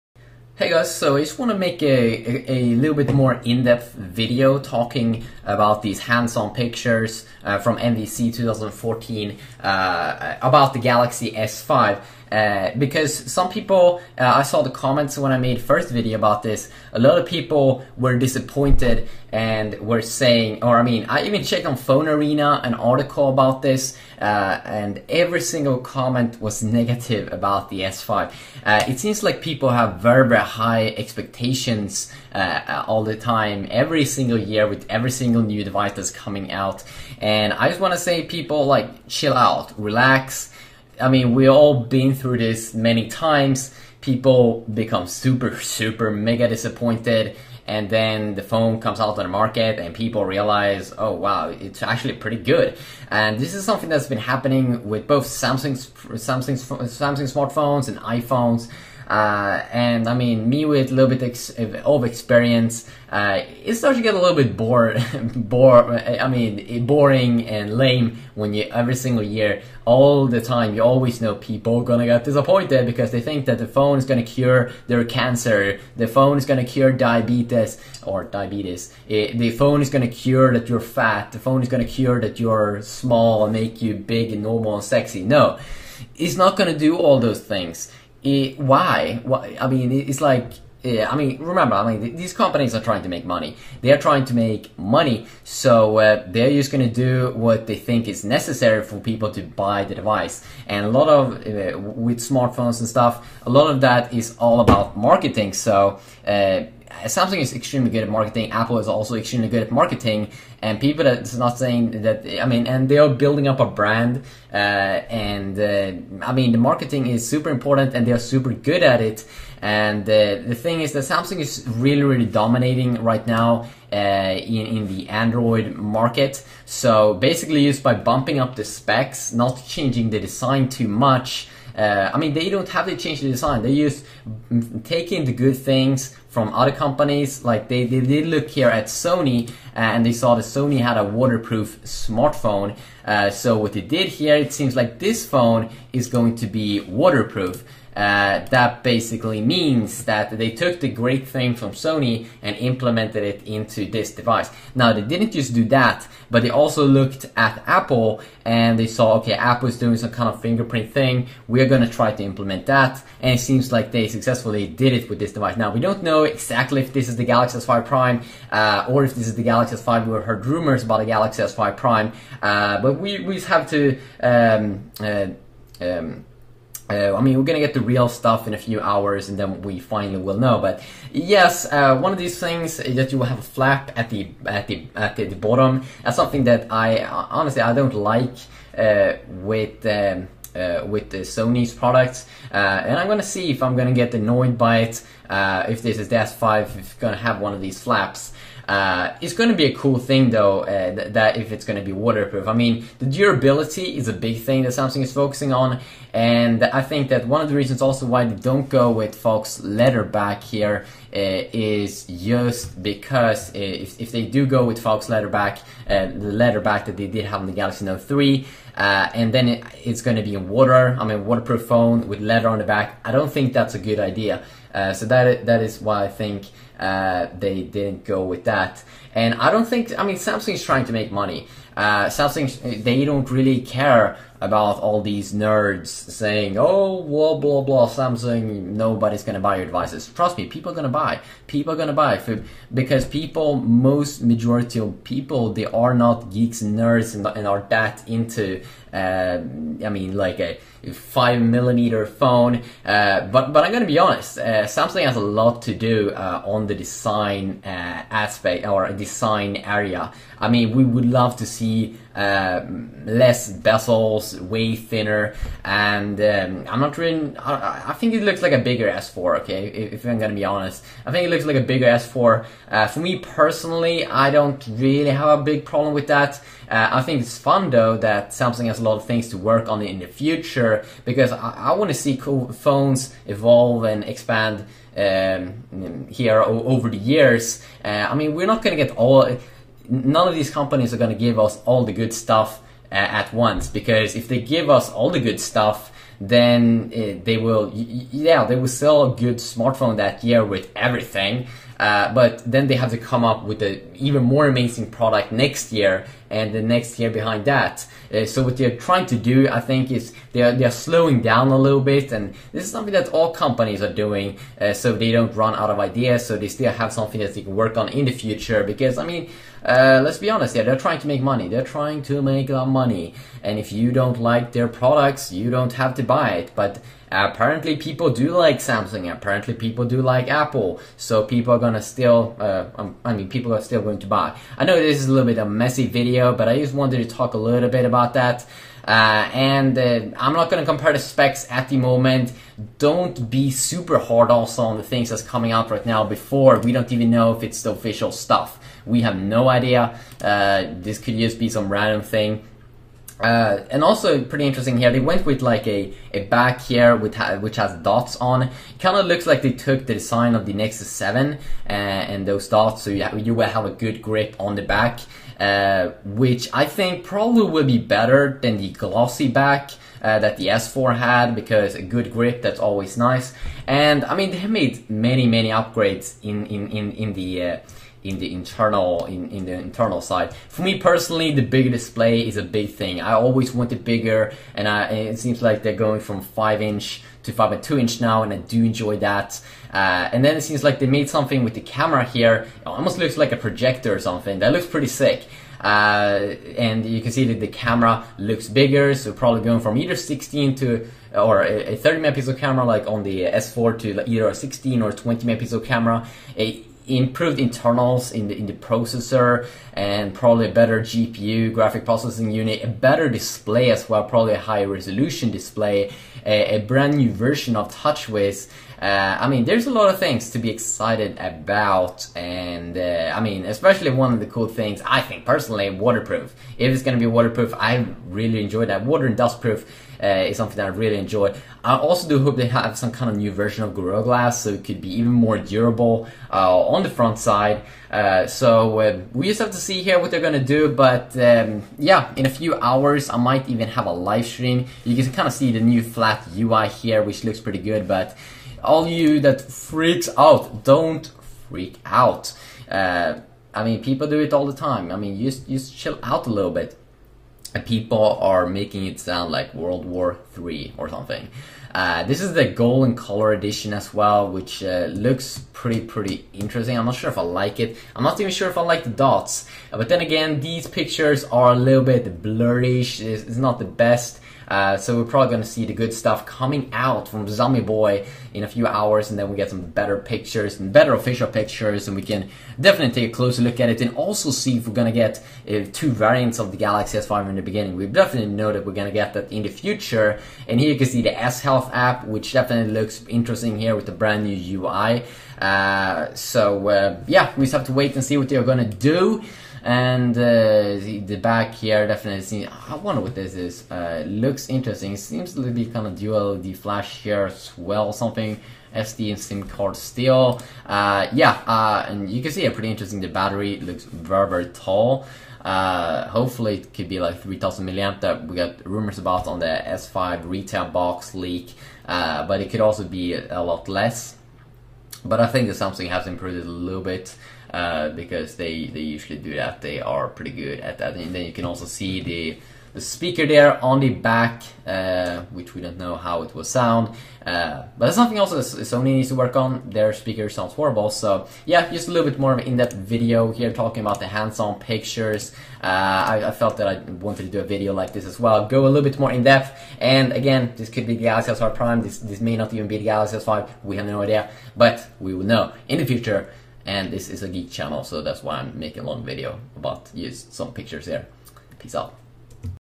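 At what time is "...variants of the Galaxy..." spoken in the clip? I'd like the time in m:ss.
8:05.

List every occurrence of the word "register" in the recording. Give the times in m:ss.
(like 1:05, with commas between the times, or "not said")
not said.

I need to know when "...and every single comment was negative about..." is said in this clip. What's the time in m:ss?
0:24.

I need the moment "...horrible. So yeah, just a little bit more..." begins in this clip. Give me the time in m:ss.
9:00.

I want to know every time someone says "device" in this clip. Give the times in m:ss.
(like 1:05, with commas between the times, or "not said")
0:35, 1:39, 2:34, 2:45, 3:59.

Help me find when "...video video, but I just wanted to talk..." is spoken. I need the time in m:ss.
5:35.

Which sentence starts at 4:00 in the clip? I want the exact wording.
Trust me, people are gonna buy.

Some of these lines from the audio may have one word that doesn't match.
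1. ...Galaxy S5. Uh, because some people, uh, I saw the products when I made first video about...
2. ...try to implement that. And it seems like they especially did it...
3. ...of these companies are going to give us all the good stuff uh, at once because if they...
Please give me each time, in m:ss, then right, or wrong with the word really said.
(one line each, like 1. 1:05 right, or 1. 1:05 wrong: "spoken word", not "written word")
1. 0:10 wrong: "comments", not "products"
2. 2:41 wrong: "successfully", not "especially"
3. 4:50 right.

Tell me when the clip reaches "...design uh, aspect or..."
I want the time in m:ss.
4:16.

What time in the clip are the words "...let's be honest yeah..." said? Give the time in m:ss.
5:20.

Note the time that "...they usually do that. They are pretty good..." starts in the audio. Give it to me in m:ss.
8:48.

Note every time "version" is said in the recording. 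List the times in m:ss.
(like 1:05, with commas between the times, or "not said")
6:57, 7:13.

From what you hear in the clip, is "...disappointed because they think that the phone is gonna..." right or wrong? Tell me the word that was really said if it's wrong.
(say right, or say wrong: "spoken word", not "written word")
right.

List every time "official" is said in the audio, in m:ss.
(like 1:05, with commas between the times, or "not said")
5:47, 8:00.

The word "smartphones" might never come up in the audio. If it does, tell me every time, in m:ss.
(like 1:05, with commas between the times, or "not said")
0:57, 1:42, 2:21, 4:59.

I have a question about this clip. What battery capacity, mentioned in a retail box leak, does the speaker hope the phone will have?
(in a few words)
3000 mAh.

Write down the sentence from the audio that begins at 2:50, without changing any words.
We've heard rumors about the Galaxy S5 Prime, uh, but we, we have to.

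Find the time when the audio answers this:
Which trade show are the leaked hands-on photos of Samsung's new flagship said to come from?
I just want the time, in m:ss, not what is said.
0:07.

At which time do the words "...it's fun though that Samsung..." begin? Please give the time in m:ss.
4:37.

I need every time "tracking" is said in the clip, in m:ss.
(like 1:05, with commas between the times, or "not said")
not said.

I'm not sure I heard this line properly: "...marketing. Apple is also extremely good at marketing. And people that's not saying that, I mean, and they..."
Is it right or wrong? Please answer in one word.
right.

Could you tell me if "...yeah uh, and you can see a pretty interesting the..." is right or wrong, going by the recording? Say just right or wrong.
right.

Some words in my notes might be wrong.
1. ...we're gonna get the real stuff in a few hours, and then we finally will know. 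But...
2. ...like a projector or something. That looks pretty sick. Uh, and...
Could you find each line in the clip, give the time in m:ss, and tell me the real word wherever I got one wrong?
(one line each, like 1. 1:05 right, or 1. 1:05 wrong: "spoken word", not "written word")
1. 2:57 right
2. 6:33 right.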